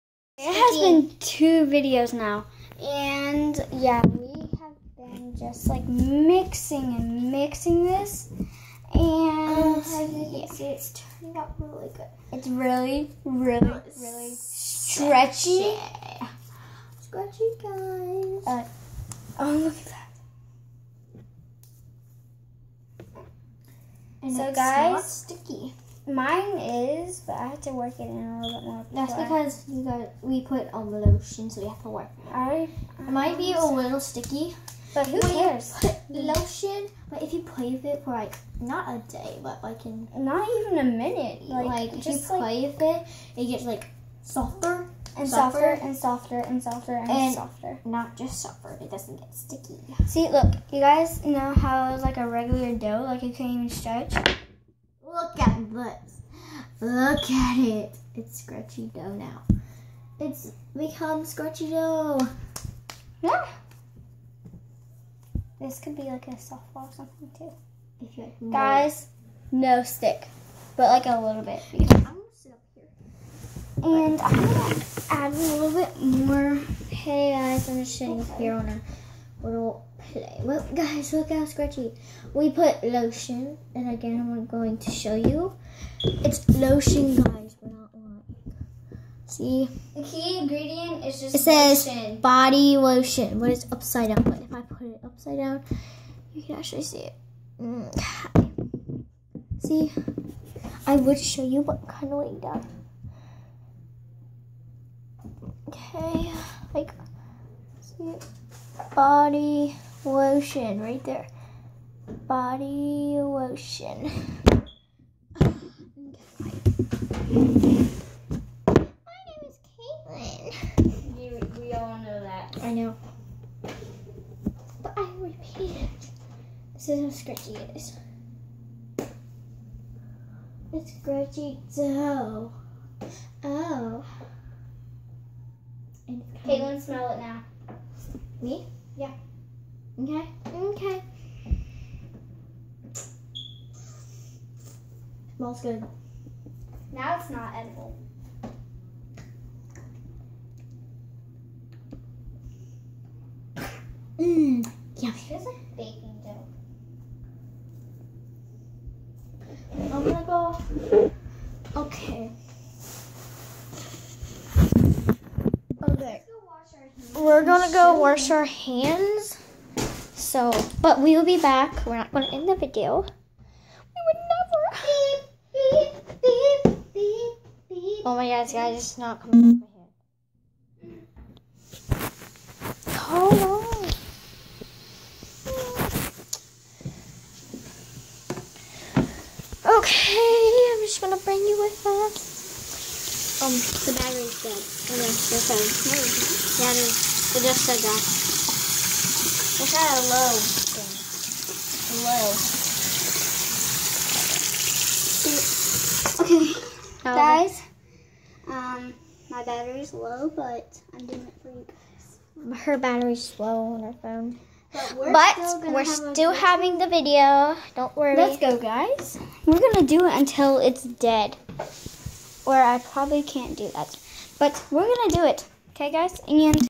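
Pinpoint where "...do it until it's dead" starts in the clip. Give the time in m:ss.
3:39.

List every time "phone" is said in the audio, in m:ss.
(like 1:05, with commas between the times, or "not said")
3:15, 3:34.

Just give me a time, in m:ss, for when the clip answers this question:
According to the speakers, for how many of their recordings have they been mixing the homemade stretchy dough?
0:01.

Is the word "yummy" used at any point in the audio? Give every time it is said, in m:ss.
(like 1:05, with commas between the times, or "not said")
2:35.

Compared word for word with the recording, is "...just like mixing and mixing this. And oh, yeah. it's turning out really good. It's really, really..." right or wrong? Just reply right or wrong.
right.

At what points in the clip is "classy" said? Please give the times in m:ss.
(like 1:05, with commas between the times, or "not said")
not said.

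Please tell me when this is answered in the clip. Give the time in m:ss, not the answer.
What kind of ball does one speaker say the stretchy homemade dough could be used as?
1:06.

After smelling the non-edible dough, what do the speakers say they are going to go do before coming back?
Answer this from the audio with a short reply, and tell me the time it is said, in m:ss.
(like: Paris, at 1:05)
wash our hands, at 2:47.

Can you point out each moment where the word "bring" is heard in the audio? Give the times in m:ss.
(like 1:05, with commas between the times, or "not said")
3:11.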